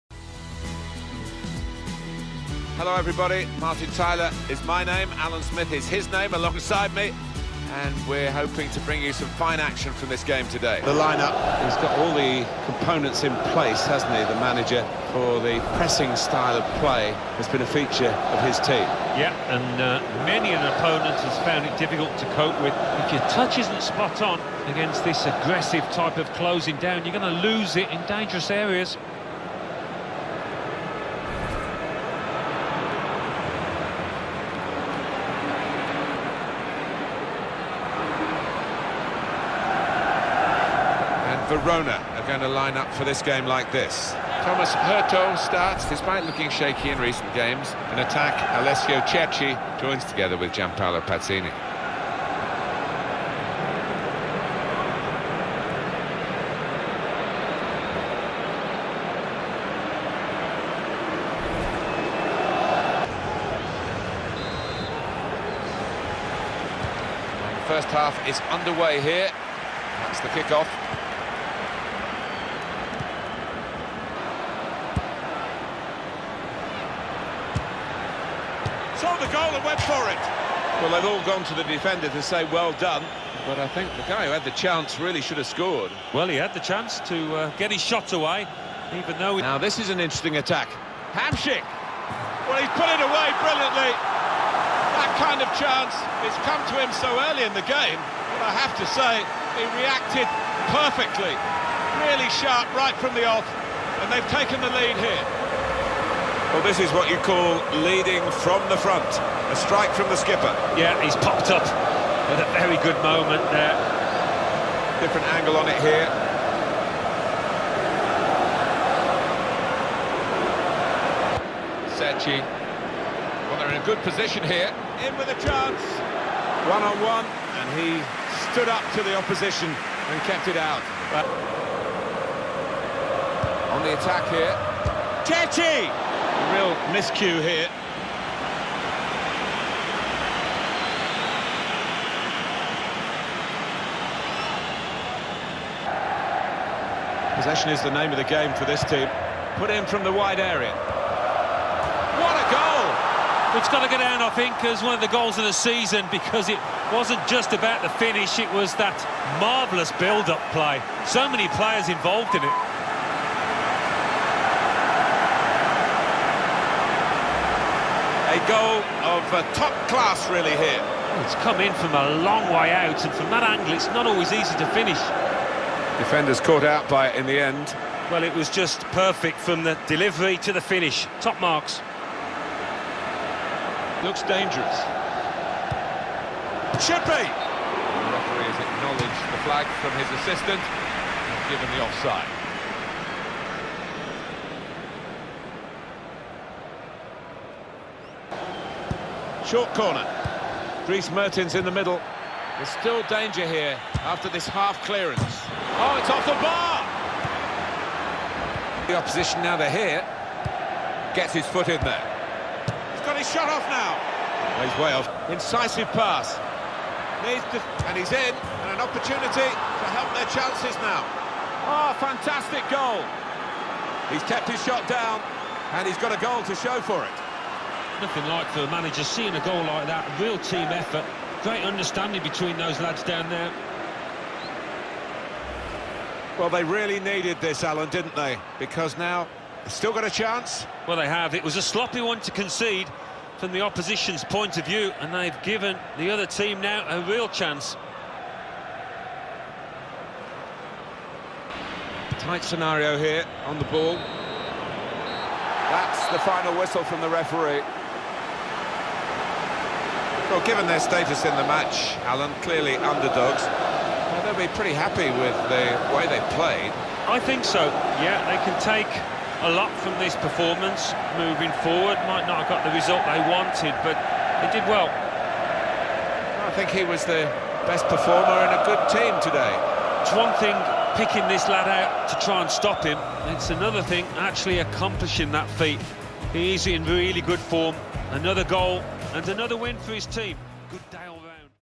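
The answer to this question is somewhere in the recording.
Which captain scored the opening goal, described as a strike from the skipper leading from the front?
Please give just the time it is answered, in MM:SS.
01:31.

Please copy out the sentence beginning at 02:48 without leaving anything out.
goal of uh, top class, really, here.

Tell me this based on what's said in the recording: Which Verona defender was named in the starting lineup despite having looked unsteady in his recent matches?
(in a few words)
Thomas Heurtaux.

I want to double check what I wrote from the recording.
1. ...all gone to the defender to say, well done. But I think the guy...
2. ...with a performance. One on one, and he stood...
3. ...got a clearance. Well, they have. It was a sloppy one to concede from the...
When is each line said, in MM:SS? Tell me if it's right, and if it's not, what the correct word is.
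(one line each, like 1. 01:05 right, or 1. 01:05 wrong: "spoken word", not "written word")
1. 01:21 right
2. 02:05 wrong: "chance", not "performance"
3. 03:59 wrong: "chance", not "clearance".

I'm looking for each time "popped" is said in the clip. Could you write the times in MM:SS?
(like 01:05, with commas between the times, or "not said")
01:51.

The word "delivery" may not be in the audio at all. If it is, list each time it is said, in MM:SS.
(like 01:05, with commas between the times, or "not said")
02:59.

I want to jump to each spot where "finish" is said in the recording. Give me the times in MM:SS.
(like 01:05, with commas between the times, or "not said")
02:37, 02:54, 03:00.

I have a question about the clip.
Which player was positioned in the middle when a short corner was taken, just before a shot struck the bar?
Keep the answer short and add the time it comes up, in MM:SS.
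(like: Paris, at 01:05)
Dries Mertens, at 03:20.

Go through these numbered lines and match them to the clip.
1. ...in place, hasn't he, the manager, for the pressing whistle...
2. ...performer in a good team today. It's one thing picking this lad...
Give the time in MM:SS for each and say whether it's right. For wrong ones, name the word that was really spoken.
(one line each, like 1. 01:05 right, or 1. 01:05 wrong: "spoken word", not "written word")
1. 00:13 wrong: "style", not "whistle"
2. 04:37 right.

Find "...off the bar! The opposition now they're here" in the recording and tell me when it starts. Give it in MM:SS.
03:26.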